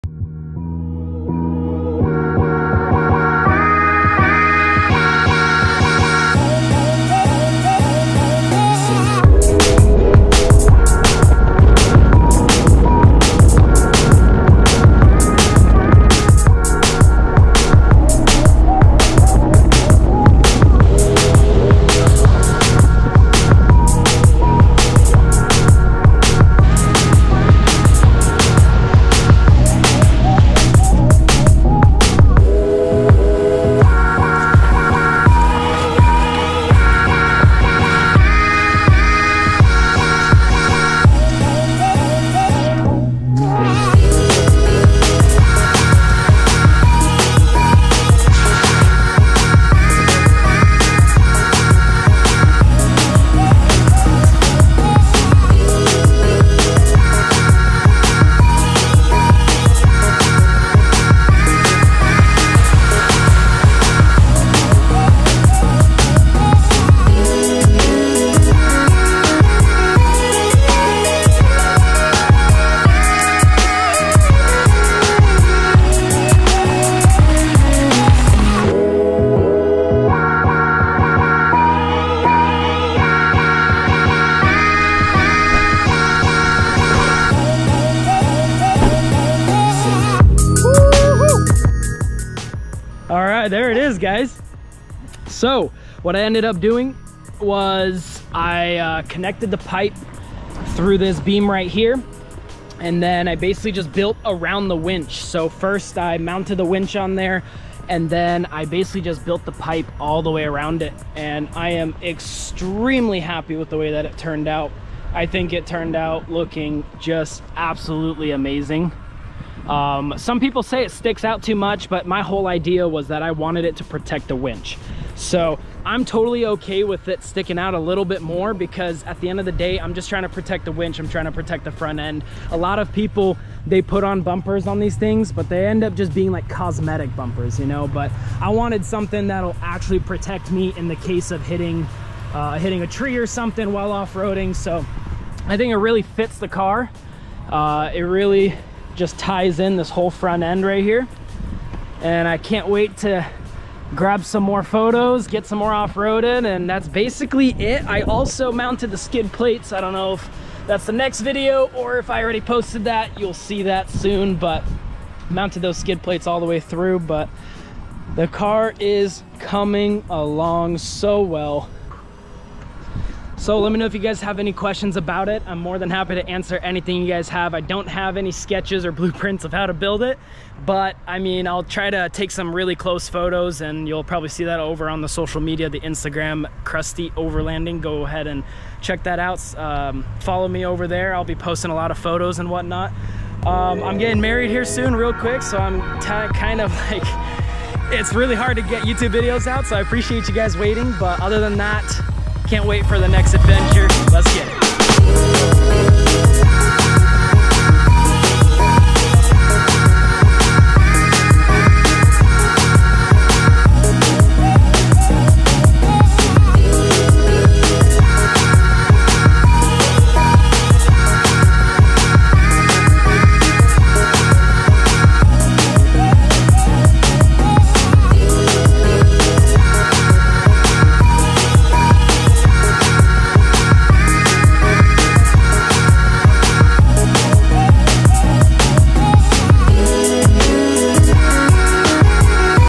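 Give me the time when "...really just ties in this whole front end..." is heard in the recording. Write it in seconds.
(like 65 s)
148 s.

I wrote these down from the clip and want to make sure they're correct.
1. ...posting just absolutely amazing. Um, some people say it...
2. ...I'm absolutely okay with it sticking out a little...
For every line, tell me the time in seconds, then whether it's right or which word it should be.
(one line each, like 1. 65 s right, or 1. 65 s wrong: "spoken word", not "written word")
1. 116 s wrong: "looking", not "posting"
2. 125 s wrong: "totally", not "absolutely".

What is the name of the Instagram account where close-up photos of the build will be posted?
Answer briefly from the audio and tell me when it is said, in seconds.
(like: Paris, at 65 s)
Crusty Overlanding, at 186 s.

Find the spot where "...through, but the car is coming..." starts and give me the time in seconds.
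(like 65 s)
166 s.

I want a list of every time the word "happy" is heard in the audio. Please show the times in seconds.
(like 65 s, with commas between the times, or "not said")
113 s, 175 s.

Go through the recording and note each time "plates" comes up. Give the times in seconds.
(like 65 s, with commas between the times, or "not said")
159 s, 166 s.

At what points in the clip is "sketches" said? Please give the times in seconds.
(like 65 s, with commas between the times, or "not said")
178 s.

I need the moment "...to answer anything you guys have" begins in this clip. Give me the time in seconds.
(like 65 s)
176 s.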